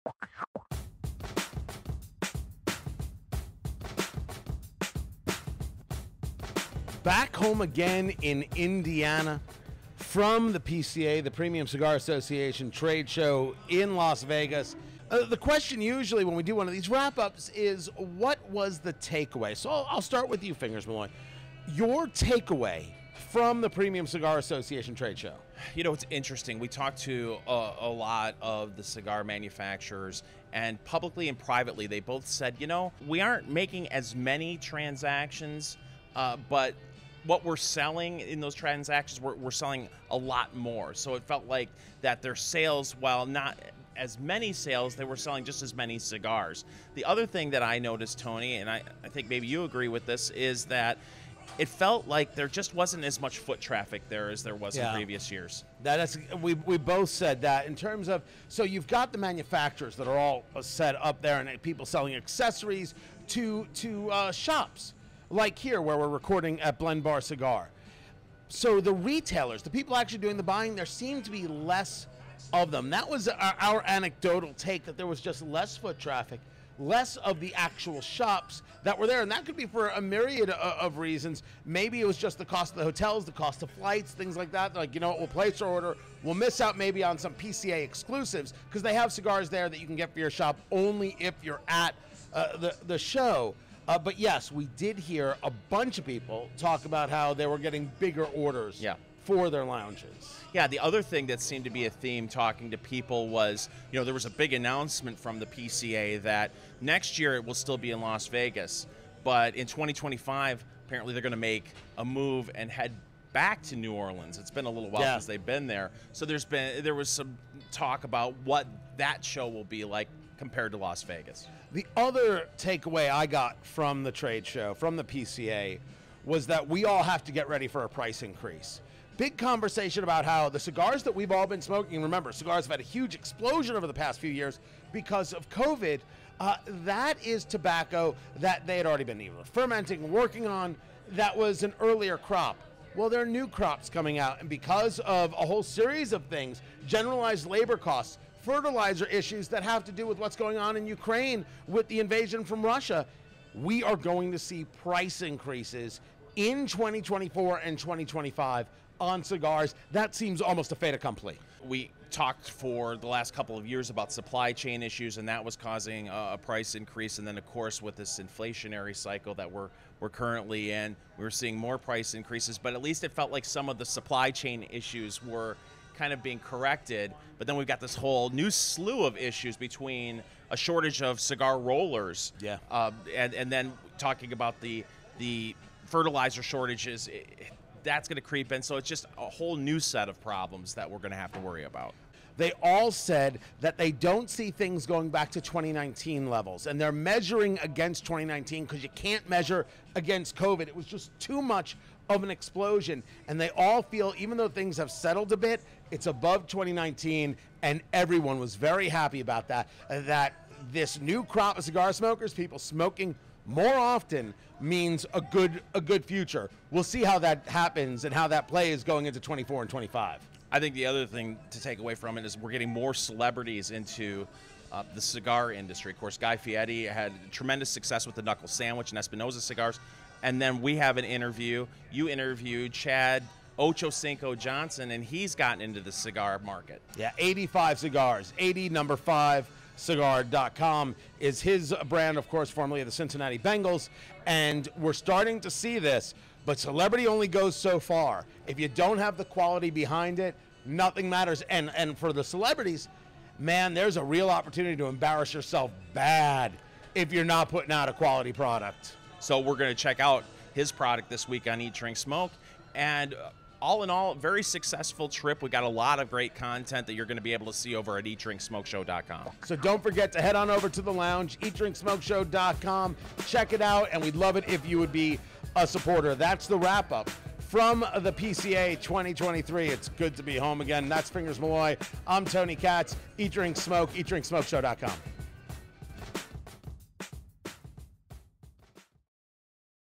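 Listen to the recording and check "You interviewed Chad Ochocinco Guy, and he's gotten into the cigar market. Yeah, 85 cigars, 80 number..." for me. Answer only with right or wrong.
wrong.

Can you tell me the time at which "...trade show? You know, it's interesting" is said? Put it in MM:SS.
00:24.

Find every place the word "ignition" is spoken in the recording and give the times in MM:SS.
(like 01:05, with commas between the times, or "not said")
not said.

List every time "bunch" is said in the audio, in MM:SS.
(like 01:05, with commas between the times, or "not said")
01:35.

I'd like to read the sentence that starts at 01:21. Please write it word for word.
Maybe it was just the cost of the hotels, the cost of flights, things like that.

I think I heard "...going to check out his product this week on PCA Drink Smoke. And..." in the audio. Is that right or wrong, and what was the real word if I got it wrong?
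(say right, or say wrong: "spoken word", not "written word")
wrong: "Eat", not "PCA".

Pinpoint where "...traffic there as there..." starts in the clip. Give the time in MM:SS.
00:53.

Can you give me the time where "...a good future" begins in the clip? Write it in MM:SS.
03:35.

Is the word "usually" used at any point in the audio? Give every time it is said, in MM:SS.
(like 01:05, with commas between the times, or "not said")
00:15.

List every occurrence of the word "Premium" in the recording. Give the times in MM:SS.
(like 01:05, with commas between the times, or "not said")
00:11, 00:23.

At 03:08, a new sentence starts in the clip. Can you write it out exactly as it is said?
So it's just a whole new set of problems that we're going to have to worry about.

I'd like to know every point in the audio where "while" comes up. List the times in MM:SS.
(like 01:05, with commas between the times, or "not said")
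00:42, 01:54.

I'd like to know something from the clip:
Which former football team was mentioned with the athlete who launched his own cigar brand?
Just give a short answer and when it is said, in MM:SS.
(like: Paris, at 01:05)
Cincinnati Bengals, at 04:02.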